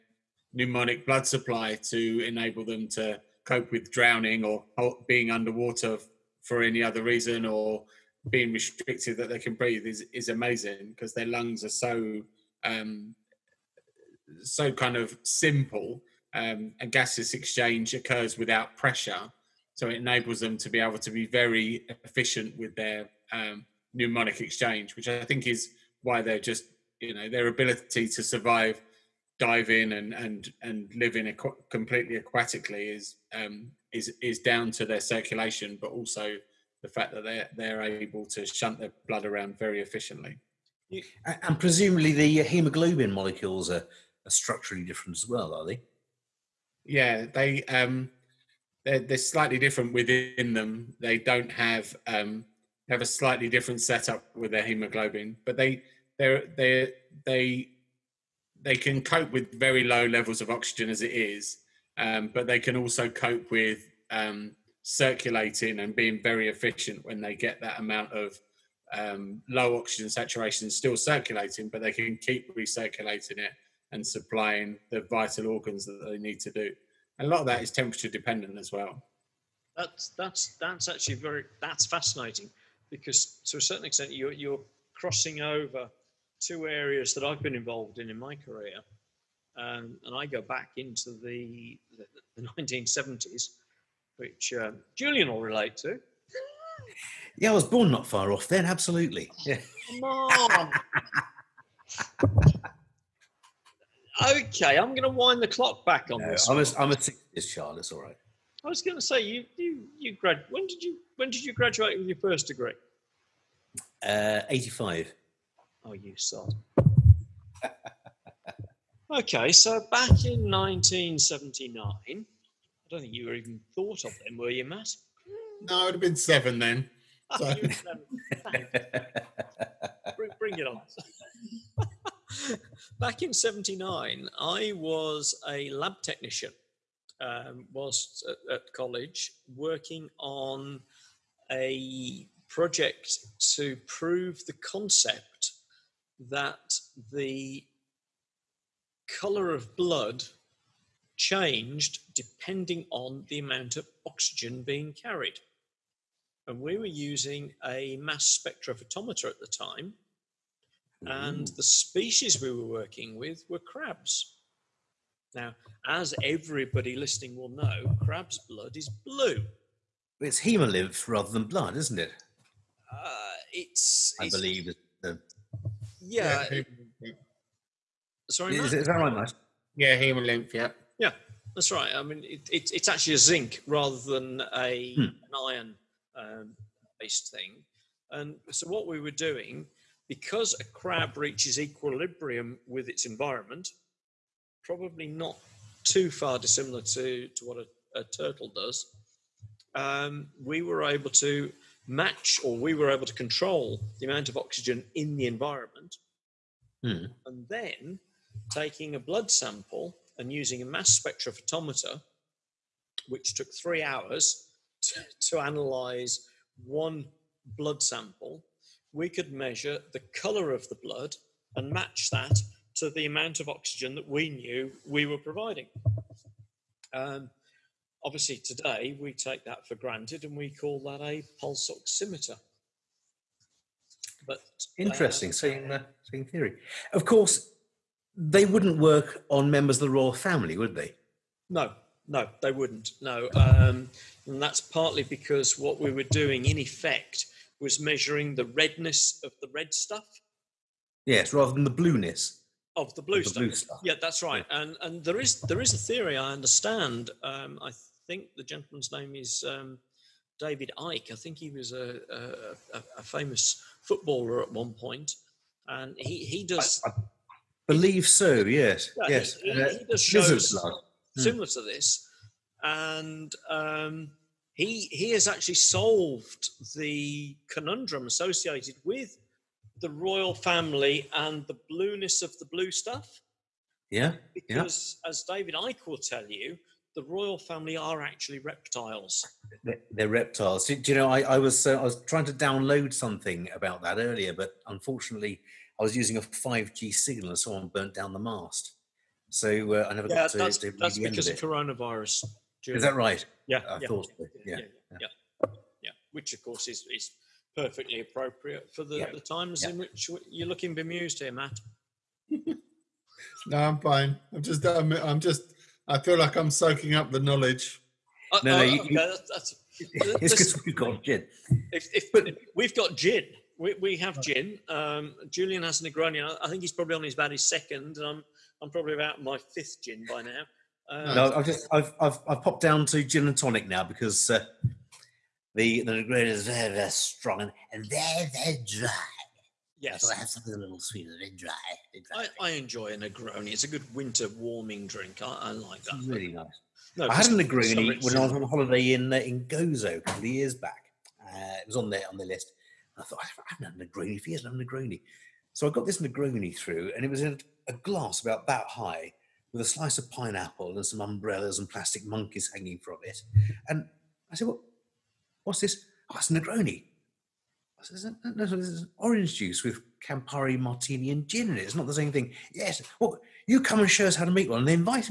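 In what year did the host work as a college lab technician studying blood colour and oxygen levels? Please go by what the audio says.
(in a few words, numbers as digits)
1979.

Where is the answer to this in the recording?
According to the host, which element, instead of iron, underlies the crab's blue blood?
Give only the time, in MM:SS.
03:03.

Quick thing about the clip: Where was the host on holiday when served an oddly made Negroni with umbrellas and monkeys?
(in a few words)
Gozo.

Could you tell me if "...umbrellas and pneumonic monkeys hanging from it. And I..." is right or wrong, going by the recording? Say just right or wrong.
wrong.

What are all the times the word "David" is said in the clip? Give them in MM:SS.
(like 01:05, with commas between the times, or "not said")
04:20, 04:45.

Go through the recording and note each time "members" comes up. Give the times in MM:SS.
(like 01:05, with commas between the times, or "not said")
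03:59.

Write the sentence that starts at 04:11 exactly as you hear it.
Yes, rather than the blueness of the blue, of the stuff.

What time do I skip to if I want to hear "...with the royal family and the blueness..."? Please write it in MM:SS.
04:38.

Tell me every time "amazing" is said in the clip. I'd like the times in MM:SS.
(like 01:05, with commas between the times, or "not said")
00:10.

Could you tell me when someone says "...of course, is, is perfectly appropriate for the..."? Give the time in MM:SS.
05:06.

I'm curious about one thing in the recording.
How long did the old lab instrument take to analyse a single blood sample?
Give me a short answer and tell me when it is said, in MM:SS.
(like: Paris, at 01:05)
Three hours, at 03:33.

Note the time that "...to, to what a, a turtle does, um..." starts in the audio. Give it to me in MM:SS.
03:16.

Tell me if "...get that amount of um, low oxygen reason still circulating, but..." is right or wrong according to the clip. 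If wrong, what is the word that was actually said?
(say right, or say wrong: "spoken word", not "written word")
wrong: "saturation", not "reason".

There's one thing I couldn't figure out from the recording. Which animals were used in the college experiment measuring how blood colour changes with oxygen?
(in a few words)
Crabs.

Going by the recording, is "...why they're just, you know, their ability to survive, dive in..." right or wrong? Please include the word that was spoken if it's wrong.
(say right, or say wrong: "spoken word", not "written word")
right.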